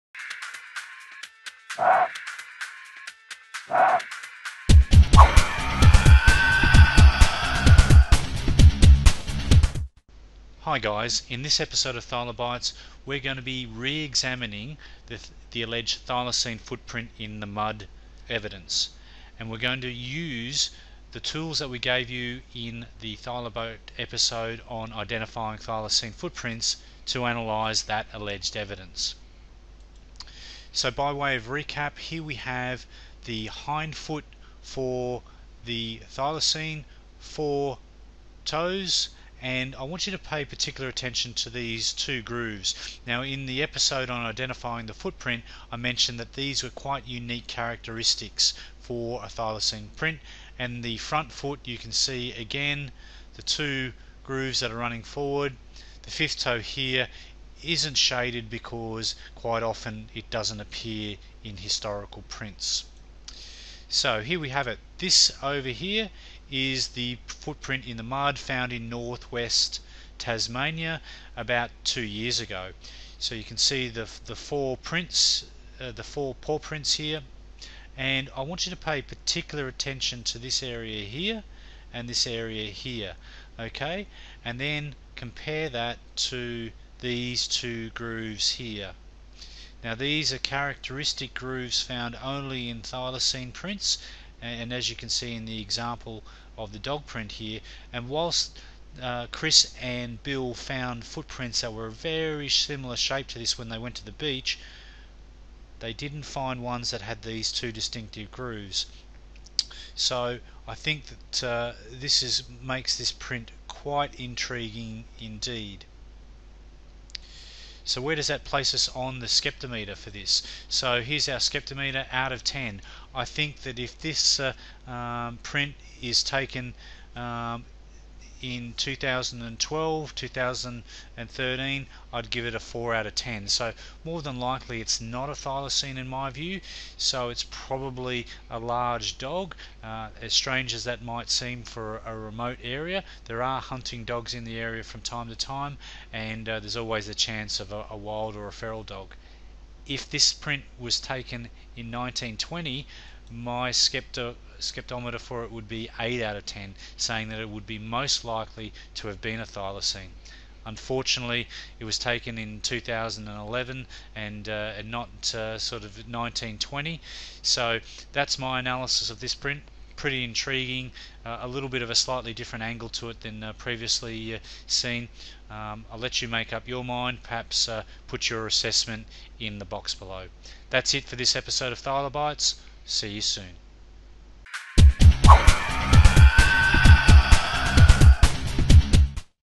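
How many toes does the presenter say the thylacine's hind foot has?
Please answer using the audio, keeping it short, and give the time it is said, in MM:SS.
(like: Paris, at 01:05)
4, at 00:37.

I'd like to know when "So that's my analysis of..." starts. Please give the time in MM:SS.
02:47.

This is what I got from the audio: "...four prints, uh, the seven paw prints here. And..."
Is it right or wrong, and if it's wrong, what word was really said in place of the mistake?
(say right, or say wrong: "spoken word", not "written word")
wrong: "four", not "seven".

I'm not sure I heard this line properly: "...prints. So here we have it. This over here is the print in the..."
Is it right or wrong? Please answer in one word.
wrong.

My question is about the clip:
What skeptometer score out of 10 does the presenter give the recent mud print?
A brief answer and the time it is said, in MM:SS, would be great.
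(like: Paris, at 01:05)
4 out of 10, at 02:12.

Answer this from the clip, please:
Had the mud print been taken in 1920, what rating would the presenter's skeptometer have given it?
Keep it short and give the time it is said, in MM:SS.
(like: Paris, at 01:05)
8 out of 10, at 02:35.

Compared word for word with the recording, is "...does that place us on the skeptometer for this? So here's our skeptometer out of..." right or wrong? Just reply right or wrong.
right.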